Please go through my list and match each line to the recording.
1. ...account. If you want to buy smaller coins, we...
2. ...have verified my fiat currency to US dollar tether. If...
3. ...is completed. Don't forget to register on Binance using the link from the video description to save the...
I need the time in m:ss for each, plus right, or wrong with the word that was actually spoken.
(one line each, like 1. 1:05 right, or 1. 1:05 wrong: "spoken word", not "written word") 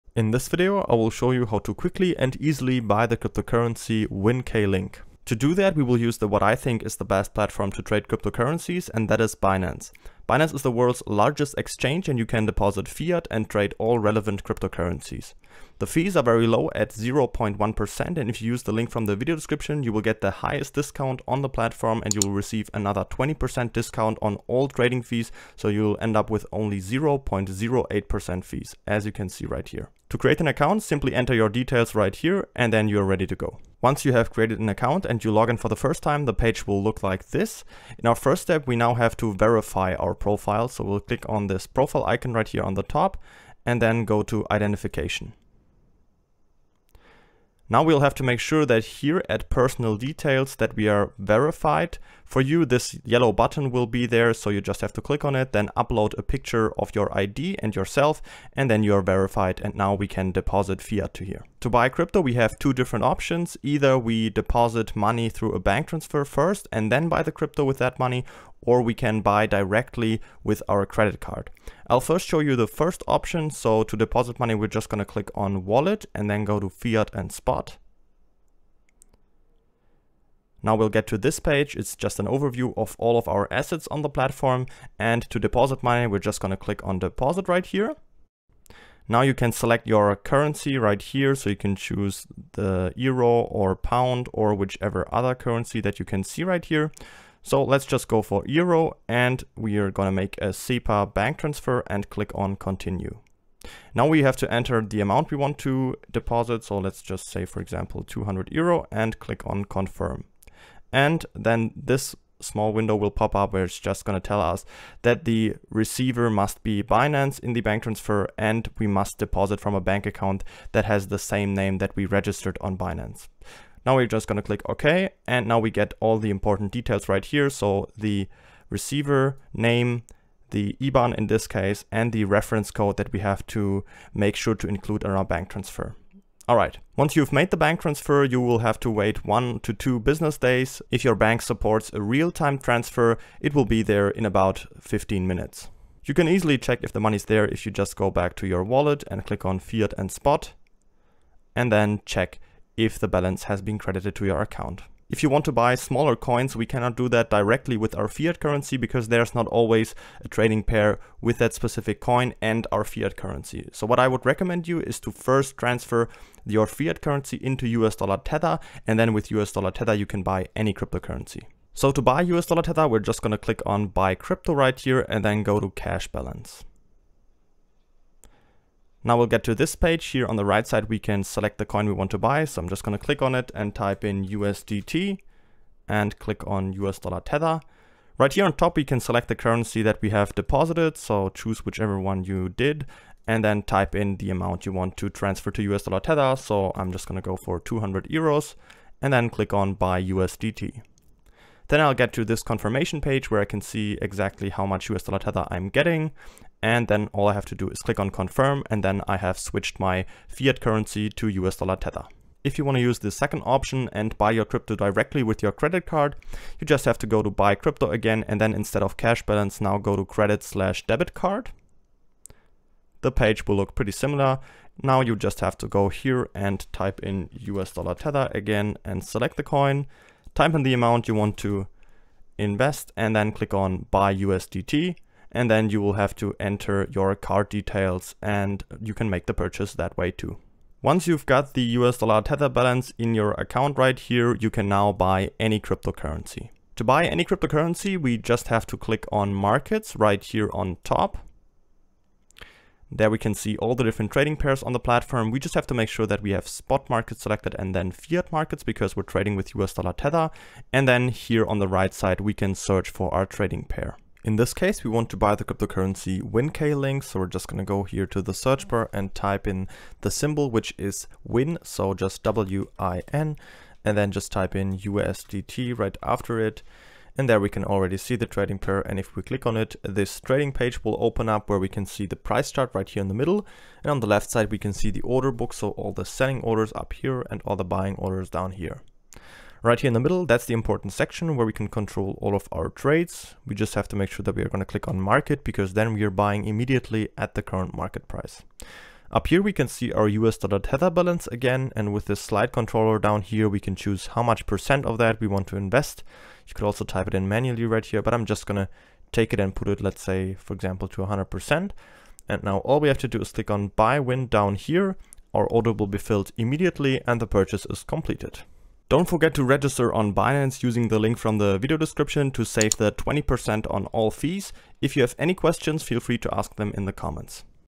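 1. 2:34 right
2. 3:29 wrong: "switched", not "verified"
3. 5:17 right.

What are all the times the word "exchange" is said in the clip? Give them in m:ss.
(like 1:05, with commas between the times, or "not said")
0:11.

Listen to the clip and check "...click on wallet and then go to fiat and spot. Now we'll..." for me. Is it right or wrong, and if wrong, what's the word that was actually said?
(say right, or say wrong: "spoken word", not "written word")
right.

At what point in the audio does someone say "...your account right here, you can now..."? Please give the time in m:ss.
4:03.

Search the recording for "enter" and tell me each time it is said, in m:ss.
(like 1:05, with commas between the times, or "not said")
0:31, 1:44, 3:56.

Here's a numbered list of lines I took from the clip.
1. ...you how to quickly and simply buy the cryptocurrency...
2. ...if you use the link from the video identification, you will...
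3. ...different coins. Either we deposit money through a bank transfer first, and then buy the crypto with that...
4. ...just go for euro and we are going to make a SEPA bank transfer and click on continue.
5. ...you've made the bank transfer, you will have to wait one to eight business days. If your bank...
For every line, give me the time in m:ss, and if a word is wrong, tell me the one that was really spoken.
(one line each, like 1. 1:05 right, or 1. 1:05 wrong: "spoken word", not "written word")
1. 0:01 wrong: "easily", not "simply"
2. 0:18 wrong: "description", not "identification"
3. 1:02 wrong: "options", not "coins"
4. 1:37 right
5. 2:17 wrong: "two", not "eight".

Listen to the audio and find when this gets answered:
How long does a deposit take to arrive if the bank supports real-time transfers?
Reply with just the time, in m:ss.
2:24.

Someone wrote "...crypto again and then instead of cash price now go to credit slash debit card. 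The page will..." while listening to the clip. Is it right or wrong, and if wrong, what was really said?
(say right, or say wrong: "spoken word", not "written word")
wrong: "balance", not "price".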